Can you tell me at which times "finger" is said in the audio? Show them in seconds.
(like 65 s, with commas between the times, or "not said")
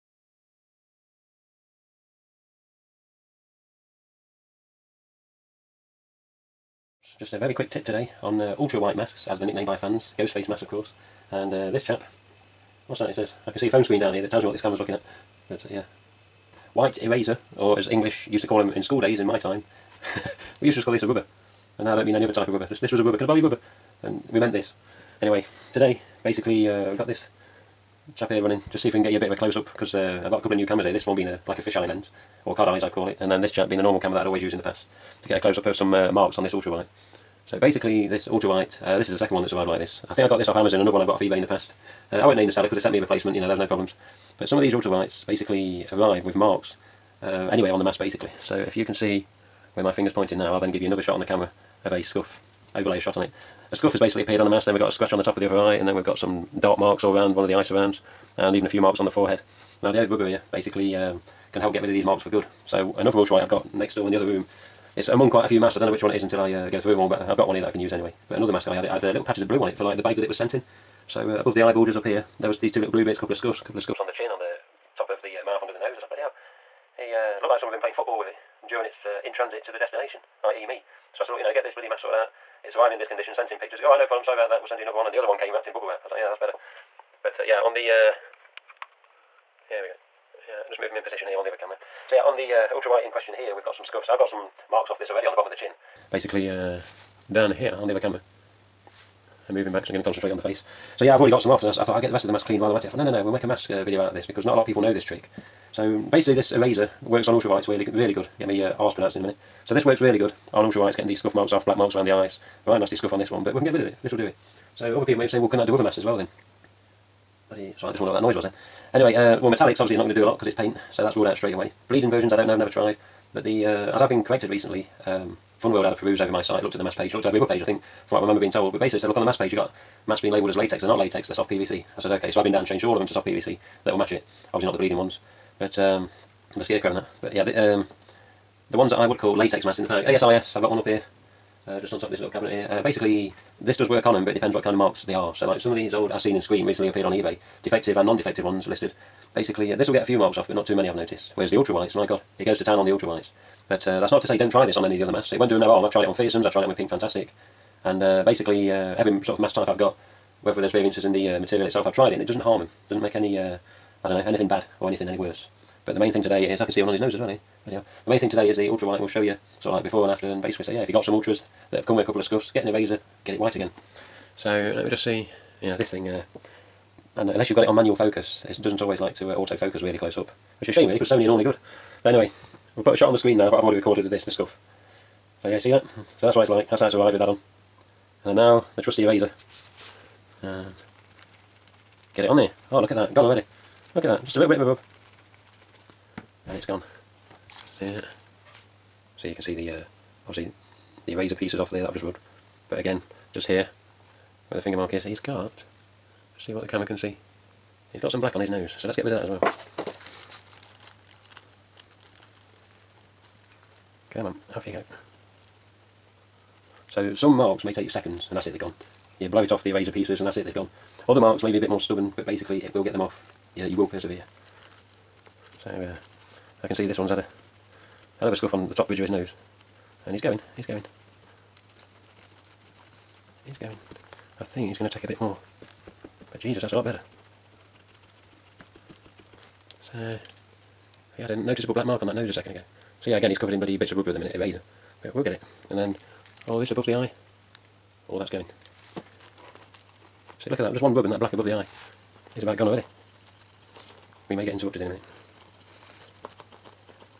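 49 s, 204 s.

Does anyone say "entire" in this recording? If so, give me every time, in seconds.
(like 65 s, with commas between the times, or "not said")
not said.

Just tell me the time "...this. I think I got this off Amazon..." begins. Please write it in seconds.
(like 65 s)
39 s.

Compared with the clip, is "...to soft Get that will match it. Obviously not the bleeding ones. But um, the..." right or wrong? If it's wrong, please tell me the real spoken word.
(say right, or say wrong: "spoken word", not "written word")
wrong: "PVC", not "Get".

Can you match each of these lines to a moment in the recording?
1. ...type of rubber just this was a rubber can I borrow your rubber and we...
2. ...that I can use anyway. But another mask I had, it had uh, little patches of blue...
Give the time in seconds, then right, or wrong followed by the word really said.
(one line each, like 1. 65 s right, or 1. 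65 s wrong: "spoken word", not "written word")
1. 22 s right
2. 67 s right.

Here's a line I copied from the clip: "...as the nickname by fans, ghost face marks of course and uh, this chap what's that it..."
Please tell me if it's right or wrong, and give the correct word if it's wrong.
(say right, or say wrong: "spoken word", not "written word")
wrong: "masks", not "marks".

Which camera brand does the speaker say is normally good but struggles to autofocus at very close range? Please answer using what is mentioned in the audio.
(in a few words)
Sony.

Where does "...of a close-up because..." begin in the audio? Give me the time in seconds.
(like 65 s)
29 s.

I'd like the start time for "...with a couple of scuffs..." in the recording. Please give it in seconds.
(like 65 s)
171 s.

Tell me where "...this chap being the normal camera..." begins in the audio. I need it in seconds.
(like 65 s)
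33 s.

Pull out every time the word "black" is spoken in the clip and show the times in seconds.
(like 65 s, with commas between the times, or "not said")
111 s, 208 s, 241 s, 251 s.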